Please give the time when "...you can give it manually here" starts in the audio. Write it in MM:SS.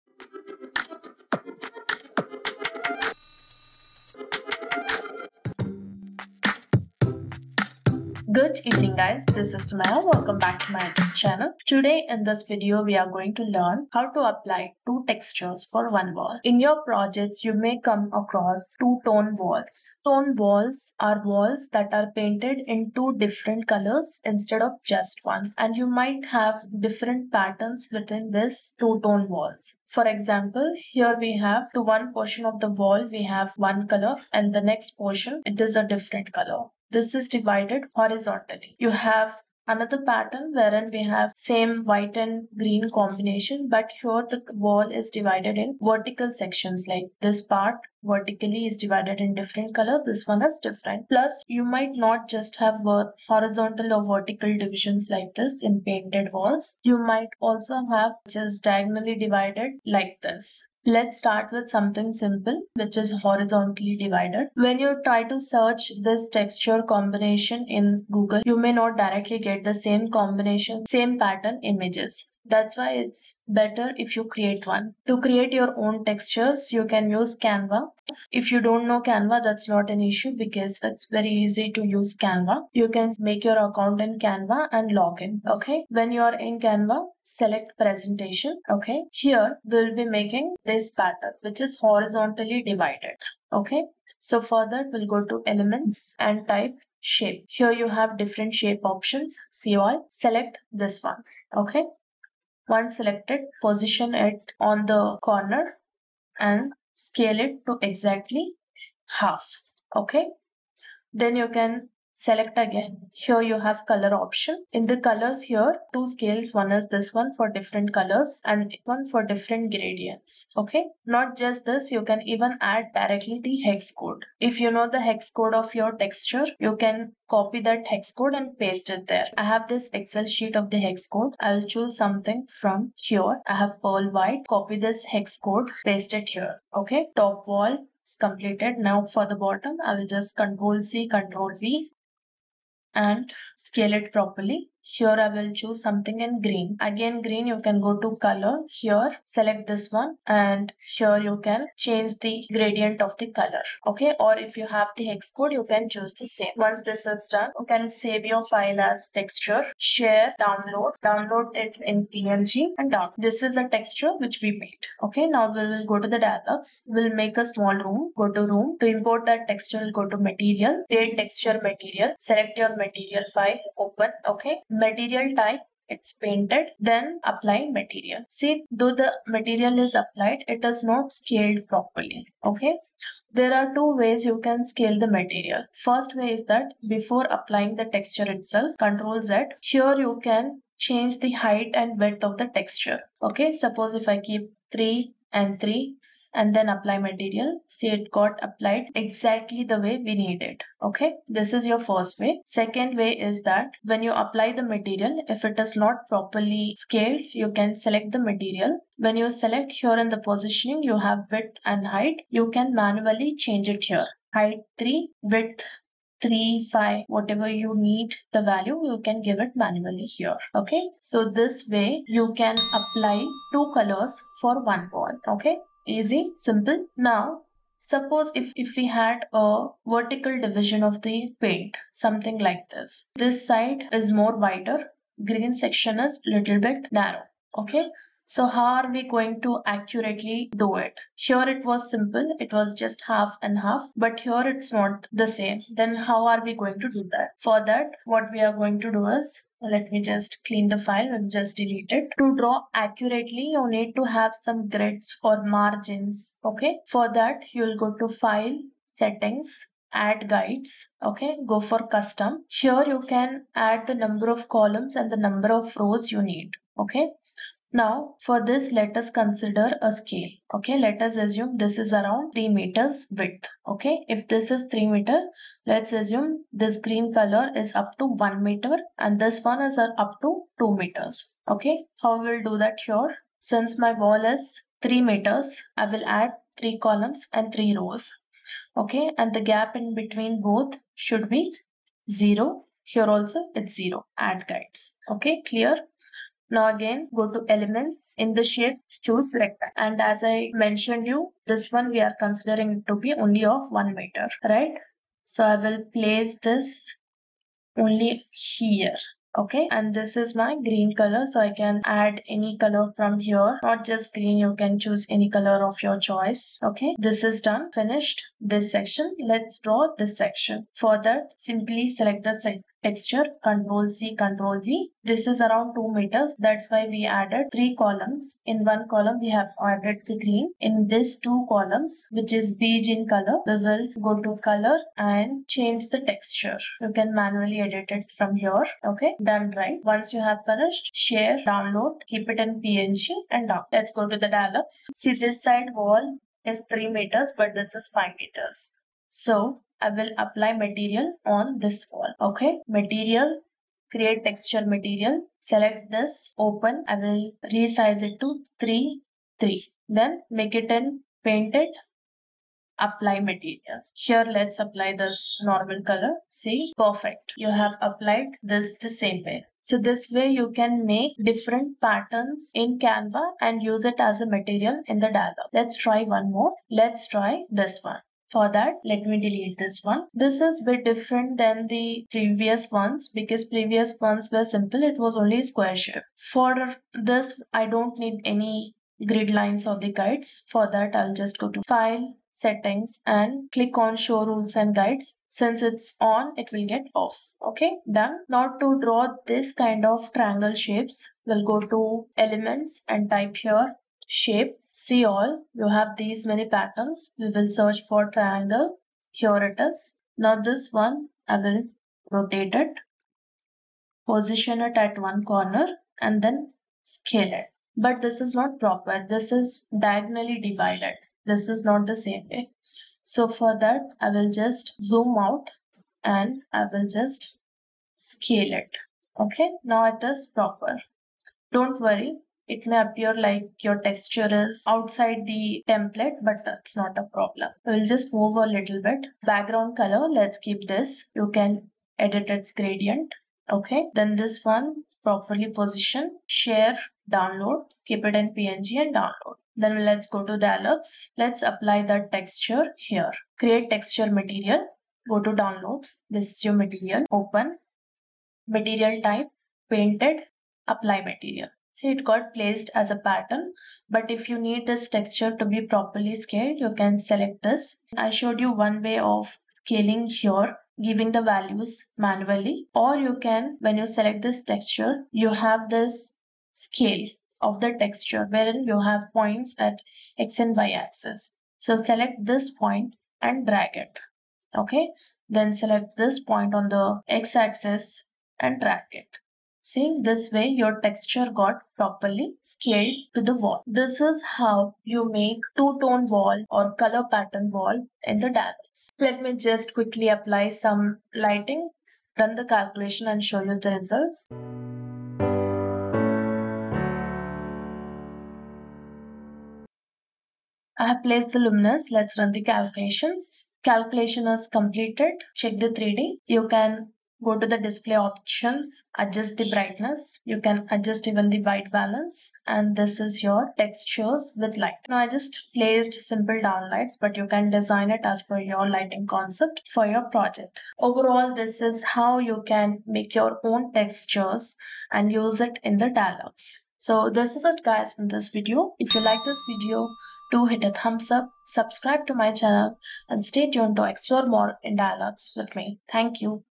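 03:38.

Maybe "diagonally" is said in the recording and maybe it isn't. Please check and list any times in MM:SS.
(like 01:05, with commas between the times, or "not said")
00:58, 06:59.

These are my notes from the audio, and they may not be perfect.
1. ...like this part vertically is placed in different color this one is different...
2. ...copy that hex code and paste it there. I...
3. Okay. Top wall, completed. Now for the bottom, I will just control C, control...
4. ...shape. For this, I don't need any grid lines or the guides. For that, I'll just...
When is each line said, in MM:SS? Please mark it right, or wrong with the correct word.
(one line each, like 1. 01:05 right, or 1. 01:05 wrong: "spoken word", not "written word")
1. 00:46 wrong: "divided", not "placed"
2. 02:07 right
3. 02:16 right
4. 06:25 right.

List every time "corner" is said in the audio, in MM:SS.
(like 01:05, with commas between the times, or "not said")
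01:45, 06:55.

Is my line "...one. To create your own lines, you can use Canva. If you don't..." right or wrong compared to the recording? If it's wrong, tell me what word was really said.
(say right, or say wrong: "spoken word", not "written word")
wrong: "textures", not "lines".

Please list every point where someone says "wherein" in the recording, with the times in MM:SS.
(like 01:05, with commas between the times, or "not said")
00:40, 07:58.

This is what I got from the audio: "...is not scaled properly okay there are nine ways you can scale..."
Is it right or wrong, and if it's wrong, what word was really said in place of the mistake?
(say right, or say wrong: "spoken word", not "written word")
wrong: "two", not "nine".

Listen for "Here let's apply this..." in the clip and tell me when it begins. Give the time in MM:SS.
06:03.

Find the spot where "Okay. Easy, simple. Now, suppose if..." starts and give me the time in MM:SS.
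03:45.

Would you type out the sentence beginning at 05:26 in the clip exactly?
That's why we added 3 columns.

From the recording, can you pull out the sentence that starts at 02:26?
Again green you can go to color.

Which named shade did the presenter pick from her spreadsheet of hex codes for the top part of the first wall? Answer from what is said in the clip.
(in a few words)
Pearl white.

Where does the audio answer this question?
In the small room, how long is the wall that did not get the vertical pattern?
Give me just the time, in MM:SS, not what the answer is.
05:47.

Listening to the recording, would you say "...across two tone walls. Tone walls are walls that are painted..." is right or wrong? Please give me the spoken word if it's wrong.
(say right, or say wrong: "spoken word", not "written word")
right.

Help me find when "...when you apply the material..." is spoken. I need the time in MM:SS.
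03:23.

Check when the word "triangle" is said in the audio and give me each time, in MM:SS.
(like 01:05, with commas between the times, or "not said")
06:40, 06:48.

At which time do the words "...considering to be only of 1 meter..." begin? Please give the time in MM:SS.
05:02.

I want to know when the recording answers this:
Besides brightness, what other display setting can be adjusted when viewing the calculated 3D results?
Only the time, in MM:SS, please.
08:41.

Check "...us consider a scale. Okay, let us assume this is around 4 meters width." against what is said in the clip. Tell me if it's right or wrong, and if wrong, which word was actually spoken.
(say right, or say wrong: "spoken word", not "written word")
wrong: "3", not "4".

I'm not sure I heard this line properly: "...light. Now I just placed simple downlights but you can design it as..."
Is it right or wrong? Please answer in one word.
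right.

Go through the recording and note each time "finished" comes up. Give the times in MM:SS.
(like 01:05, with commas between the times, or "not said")
05:17, 05:40.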